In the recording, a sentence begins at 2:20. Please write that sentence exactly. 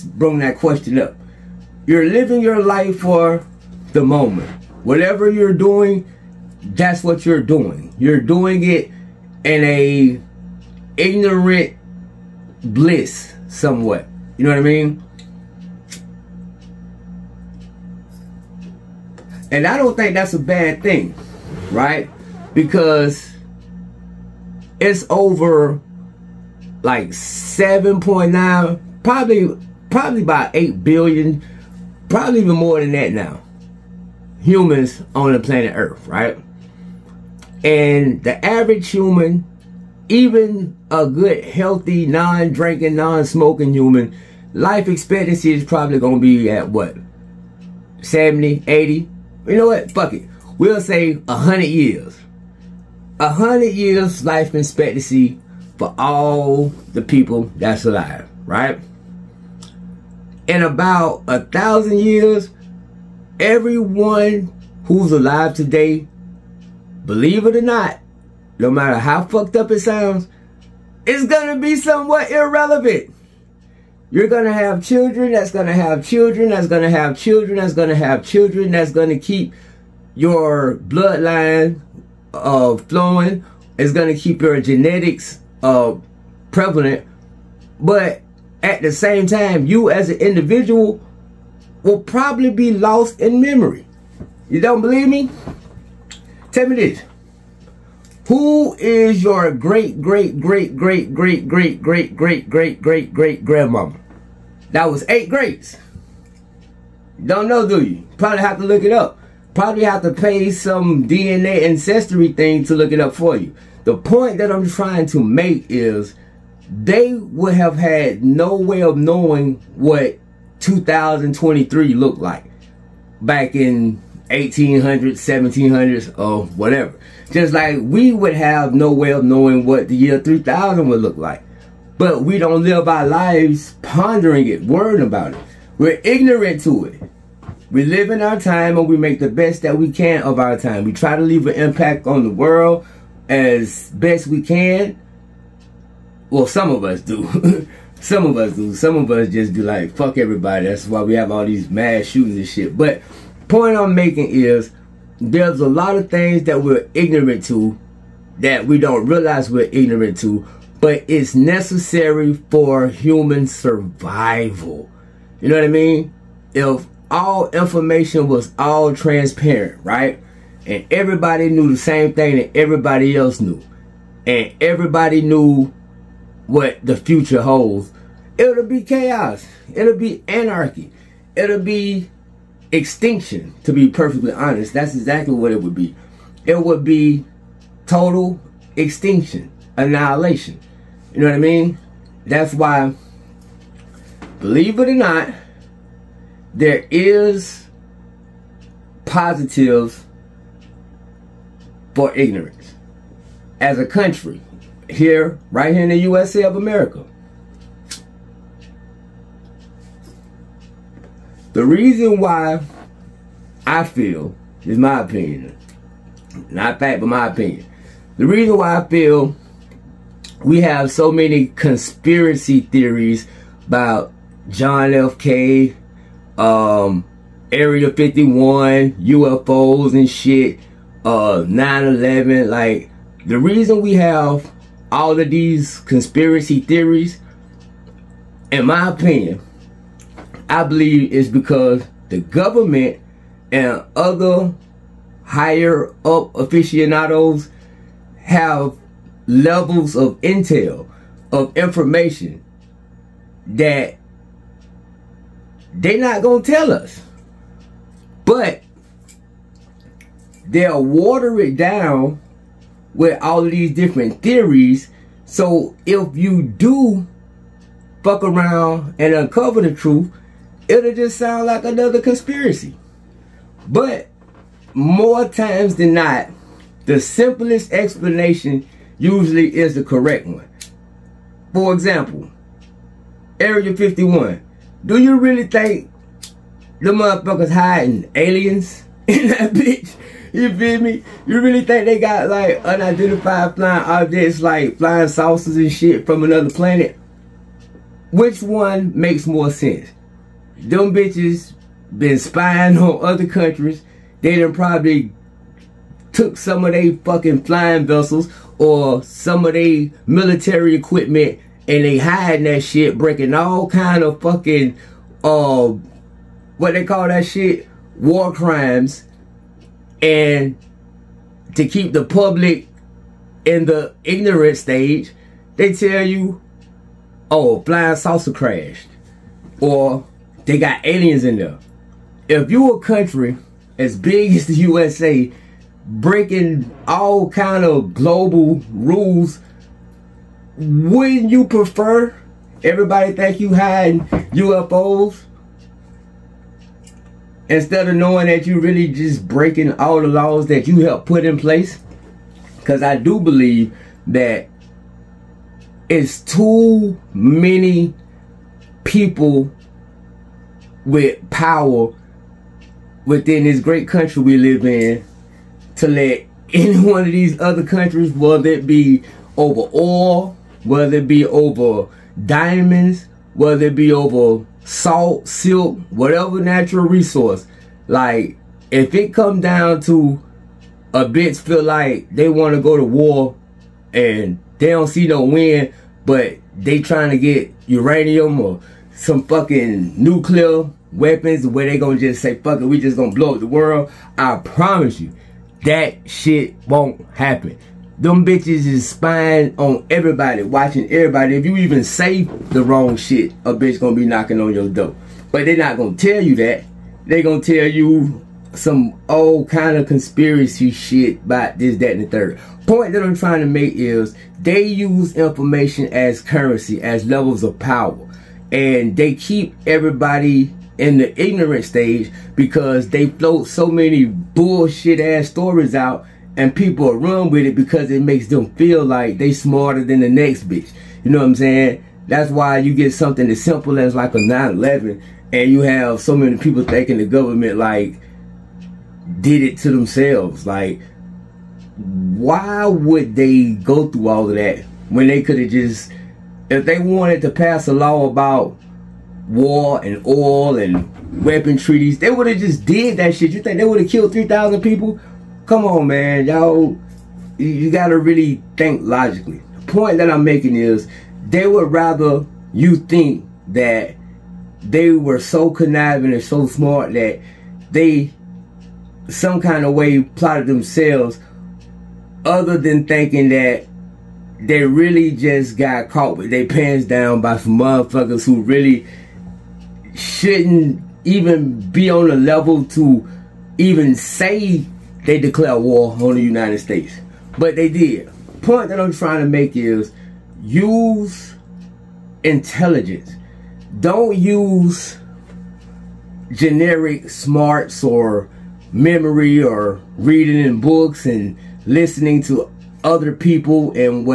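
We try to leave an impact on the world as best we can.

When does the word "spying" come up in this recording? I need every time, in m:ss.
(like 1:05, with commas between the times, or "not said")
5:02, 6:38.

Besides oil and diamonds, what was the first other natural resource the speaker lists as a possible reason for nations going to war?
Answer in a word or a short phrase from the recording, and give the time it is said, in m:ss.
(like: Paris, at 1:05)
salt, at 6:14.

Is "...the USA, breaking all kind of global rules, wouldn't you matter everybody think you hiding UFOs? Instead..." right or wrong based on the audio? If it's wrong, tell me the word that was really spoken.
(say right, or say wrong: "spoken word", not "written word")
wrong: "prefer", not "matter".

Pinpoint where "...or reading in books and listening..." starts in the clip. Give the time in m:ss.
8:19.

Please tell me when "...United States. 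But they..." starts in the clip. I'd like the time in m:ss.
8:06.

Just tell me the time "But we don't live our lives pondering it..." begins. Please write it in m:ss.
2:11.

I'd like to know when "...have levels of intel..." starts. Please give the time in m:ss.
4:08.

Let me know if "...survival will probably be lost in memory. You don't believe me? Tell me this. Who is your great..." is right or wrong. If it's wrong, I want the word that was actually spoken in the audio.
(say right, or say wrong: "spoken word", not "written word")
wrong: "individual", not "survival".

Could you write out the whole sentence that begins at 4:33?
But more times than not, the simplest explanation usually is the correct one.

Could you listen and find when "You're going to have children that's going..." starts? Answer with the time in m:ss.
1:14.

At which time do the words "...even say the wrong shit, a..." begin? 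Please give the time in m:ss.
6:41.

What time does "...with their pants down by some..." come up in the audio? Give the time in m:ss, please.
7:56.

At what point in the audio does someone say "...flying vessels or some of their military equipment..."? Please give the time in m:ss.
5:07.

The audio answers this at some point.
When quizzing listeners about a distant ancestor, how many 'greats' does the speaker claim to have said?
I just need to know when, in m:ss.
1:45.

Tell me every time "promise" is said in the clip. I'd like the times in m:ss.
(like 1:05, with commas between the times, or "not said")
6:34.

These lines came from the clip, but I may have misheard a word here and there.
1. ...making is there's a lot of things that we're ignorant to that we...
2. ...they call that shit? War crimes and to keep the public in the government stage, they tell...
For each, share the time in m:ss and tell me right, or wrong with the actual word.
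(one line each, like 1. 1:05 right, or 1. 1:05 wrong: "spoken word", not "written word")
1. 2:33 right
2. 5:16 wrong: "ignorant", not "government".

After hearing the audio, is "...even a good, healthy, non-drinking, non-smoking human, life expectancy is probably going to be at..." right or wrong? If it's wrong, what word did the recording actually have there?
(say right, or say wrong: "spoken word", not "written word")
right.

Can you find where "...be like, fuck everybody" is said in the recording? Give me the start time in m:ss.
2:29.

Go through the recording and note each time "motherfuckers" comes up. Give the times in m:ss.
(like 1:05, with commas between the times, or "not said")
4:46, 7:57.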